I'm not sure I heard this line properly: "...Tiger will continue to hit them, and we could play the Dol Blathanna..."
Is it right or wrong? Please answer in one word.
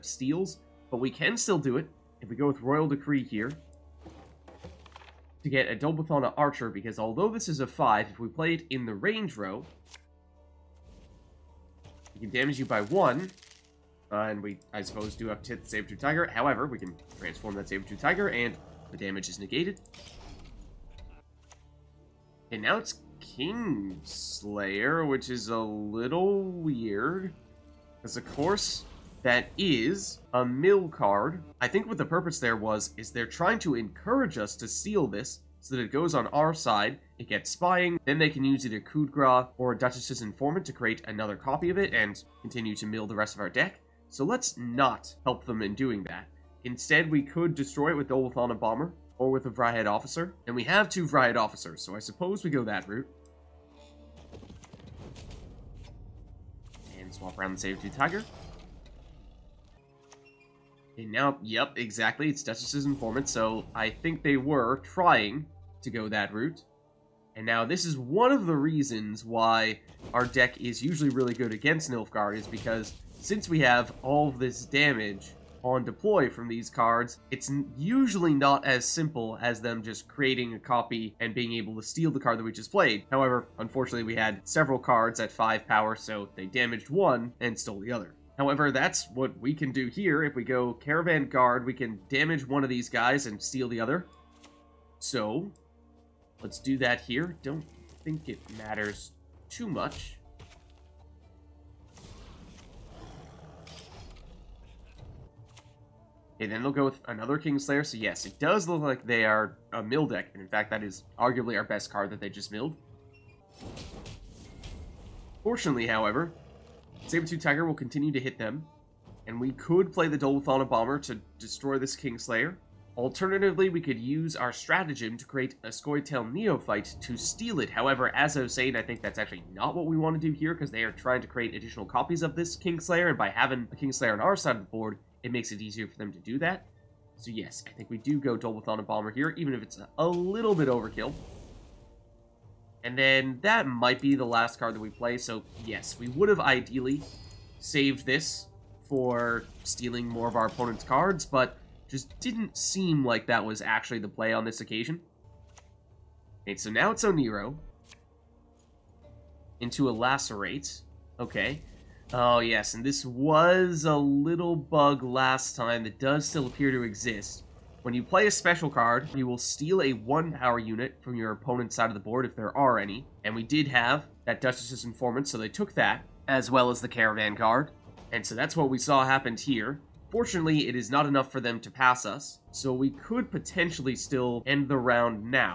right.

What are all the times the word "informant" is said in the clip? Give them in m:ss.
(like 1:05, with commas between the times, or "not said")
0:40, 1:02, 2:54.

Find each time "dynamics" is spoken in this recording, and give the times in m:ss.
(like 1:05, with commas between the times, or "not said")
not said.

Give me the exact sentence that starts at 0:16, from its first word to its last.
However, we can transform that Sabertooth Tiger, and the damage is negated.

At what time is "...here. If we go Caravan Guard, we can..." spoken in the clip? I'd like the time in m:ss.
1:29.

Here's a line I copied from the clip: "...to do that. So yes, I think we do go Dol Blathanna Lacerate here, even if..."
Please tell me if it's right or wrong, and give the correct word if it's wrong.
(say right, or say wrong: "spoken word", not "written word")
wrong: "Bomber", not "Lacerate".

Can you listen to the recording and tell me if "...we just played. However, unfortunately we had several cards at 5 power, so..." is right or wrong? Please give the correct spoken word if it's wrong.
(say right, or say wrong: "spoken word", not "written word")
right.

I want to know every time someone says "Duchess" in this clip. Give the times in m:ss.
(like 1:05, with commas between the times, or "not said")
0:39, 1:02, 2:54.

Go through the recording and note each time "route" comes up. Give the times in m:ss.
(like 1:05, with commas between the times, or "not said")
0:52, 1:06.